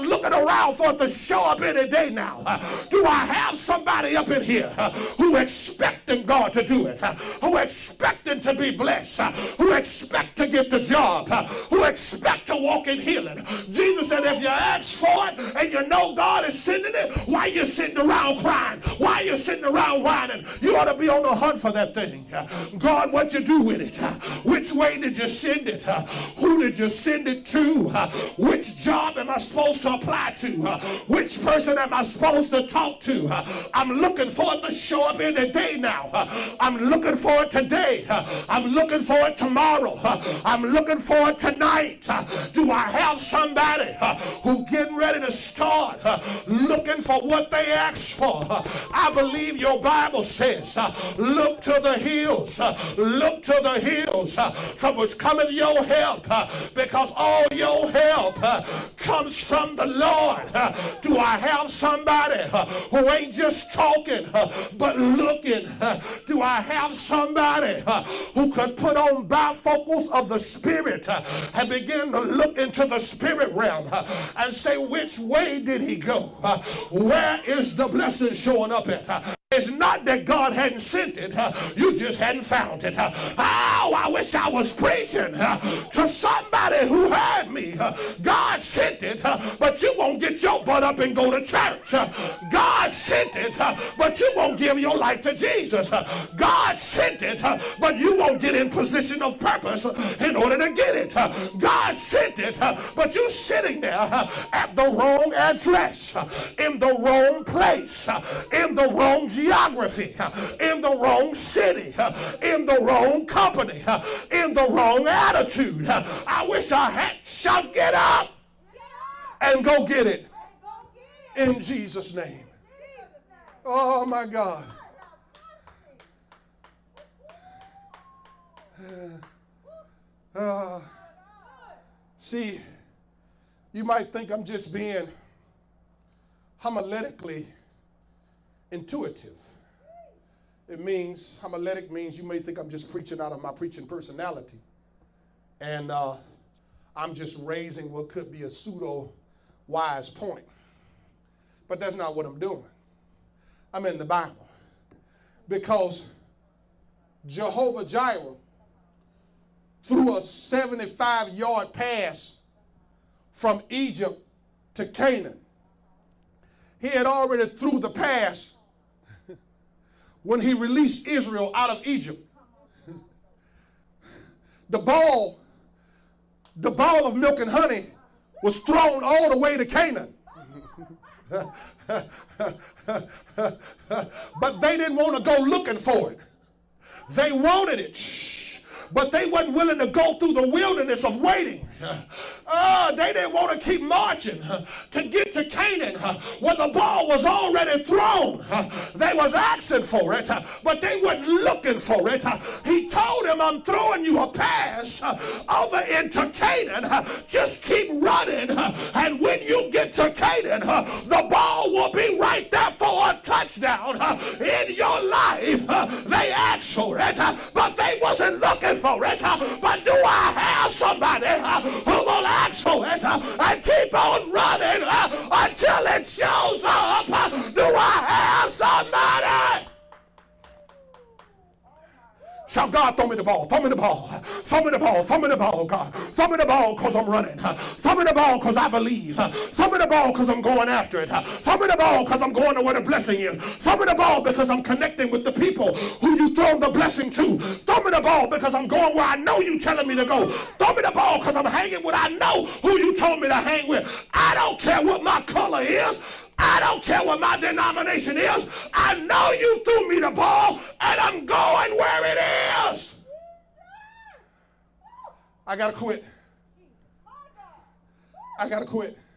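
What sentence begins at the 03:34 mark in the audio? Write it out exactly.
In your life, they asked for it, but they wasn't looking for it.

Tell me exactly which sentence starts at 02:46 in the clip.
He had already threw the pass when he released Israel out of Egypt.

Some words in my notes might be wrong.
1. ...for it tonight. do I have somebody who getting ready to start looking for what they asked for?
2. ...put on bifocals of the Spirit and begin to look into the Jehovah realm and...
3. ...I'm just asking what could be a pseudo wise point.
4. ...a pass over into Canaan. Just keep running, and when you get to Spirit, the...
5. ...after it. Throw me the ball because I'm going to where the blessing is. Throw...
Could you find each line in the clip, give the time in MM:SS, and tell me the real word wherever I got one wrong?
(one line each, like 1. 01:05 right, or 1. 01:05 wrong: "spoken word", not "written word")
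1. 00:40 right
2. 01:08 wrong: "Spirit", not "Jehovah"
3. 02:26 wrong: "raising", not "asking"
4. 03:24 wrong: "Canaan", not "Spirit"
5. 04:00 right.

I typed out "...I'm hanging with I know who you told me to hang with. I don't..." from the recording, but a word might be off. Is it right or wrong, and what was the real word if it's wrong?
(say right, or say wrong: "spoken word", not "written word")
right.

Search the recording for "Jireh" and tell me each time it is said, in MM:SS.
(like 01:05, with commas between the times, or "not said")
02:37.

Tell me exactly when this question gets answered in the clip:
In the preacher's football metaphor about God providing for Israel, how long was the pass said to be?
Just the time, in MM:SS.
02:40.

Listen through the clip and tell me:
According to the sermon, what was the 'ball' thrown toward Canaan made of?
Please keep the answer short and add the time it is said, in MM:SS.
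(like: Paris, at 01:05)
milk and honey, at 02:57.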